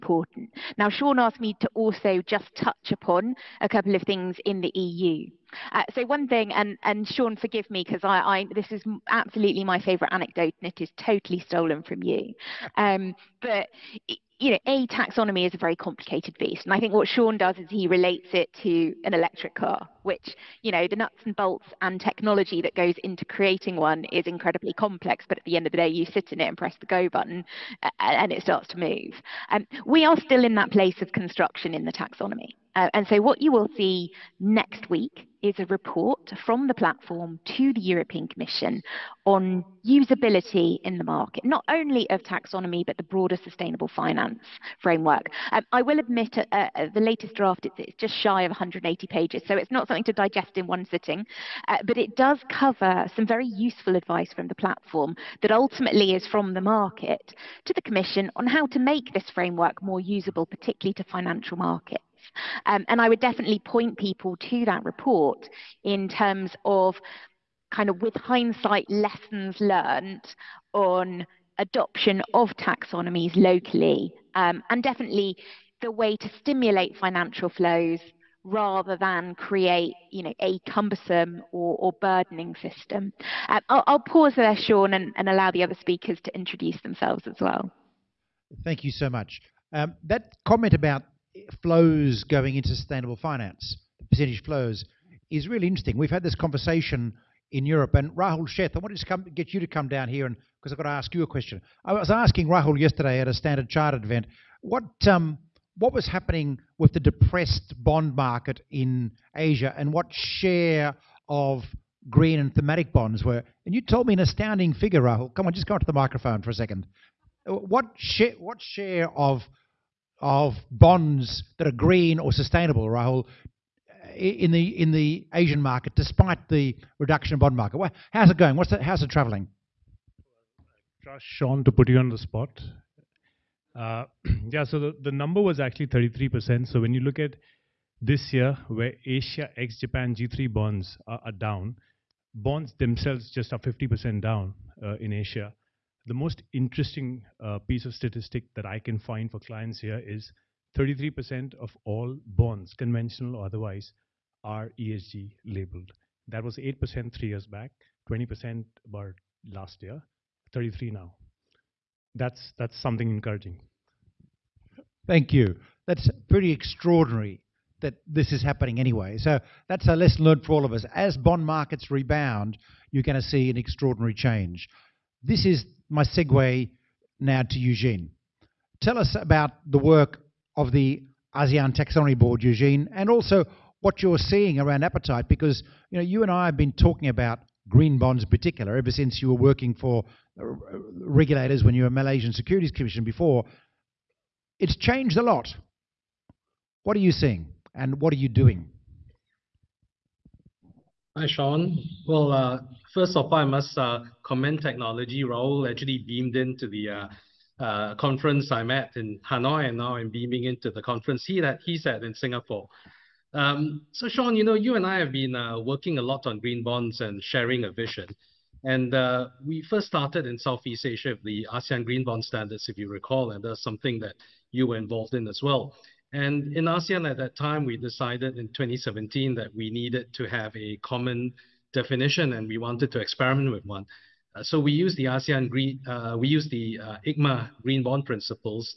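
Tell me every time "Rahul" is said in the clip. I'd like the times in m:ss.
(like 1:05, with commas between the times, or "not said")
1:38, 1:42, 1:55, 2:02, 3:25.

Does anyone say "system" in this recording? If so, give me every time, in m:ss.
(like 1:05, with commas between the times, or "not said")
1:22.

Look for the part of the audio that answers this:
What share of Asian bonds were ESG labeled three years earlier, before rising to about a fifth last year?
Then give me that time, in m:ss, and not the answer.
2:36.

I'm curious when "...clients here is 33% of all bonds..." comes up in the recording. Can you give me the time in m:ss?
2:29.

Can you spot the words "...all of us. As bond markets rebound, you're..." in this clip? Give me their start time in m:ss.
2:50.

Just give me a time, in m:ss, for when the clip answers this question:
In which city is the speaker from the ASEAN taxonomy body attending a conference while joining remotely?
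3:29.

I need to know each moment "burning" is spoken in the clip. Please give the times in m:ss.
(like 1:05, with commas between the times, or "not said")
not said.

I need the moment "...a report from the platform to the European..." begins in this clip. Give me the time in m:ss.
0:35.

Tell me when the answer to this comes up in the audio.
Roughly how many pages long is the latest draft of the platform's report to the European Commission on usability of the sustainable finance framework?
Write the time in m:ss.
0:48.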